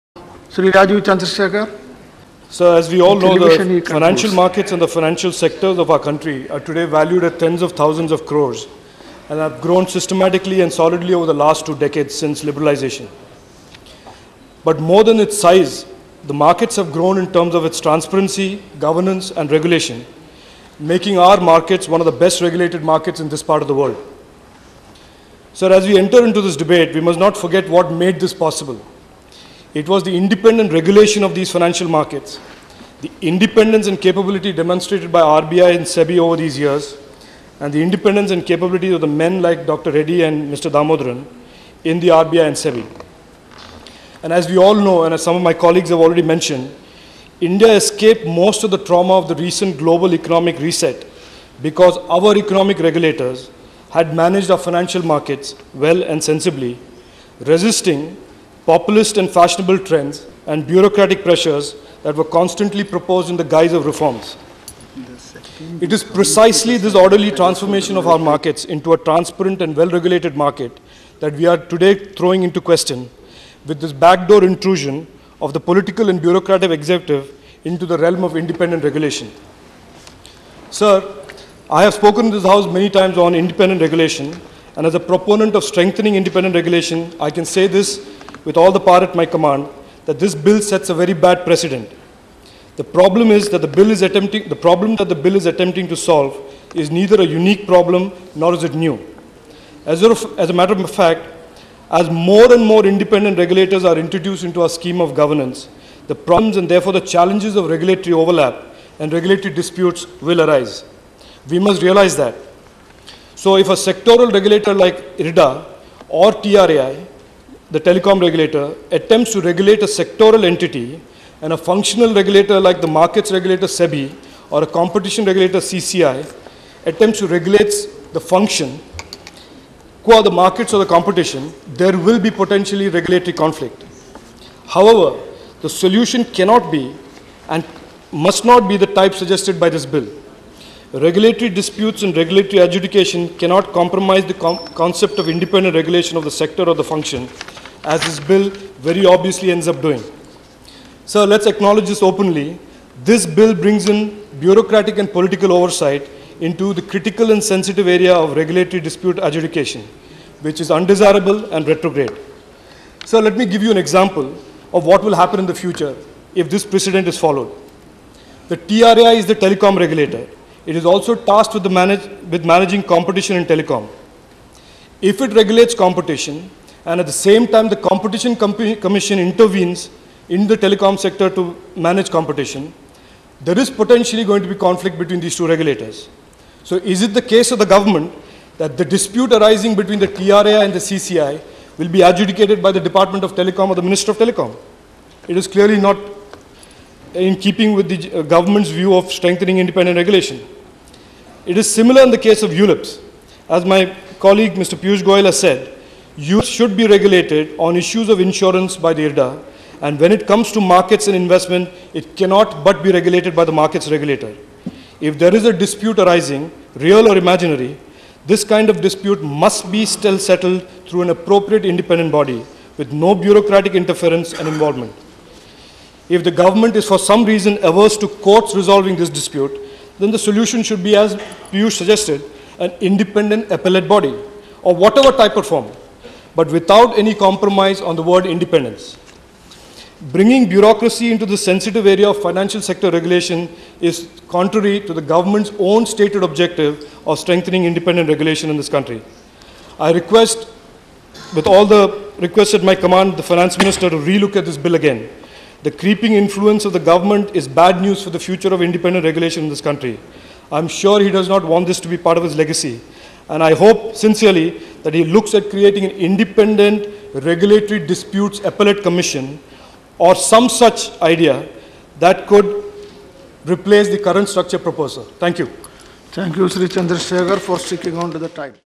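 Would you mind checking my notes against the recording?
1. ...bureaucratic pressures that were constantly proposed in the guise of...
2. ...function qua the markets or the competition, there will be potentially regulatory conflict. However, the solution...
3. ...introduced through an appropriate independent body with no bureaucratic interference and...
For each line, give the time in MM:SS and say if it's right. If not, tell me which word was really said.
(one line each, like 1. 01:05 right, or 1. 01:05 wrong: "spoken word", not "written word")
1. 01:00 right
2. 02:08 right
3. 03:40 wrong: "settled", not "introduced".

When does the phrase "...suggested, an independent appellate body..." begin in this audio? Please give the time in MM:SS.
03:51.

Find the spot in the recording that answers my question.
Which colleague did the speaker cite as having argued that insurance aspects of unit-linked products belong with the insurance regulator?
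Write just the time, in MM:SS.
03:24.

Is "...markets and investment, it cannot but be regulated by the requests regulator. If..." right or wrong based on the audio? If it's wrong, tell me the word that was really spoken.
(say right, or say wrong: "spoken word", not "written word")
wrong: "markets", not "requests".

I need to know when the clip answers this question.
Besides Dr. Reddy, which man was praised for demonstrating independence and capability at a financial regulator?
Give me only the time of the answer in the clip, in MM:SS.
00:40.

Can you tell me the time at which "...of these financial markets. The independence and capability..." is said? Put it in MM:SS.
00:31.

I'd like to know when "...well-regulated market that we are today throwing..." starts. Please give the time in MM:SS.
01:09.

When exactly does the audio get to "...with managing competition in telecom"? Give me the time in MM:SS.
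02:52.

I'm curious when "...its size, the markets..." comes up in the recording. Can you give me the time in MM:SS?
00:15.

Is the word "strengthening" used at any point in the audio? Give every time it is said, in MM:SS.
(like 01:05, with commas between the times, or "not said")
01:25, 03:19, 04:07.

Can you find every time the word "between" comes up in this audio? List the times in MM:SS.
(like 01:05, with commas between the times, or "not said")
03:04, 03:09.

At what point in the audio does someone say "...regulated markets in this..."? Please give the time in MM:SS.
00:22.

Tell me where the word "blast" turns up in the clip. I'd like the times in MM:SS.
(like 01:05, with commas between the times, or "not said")
not said.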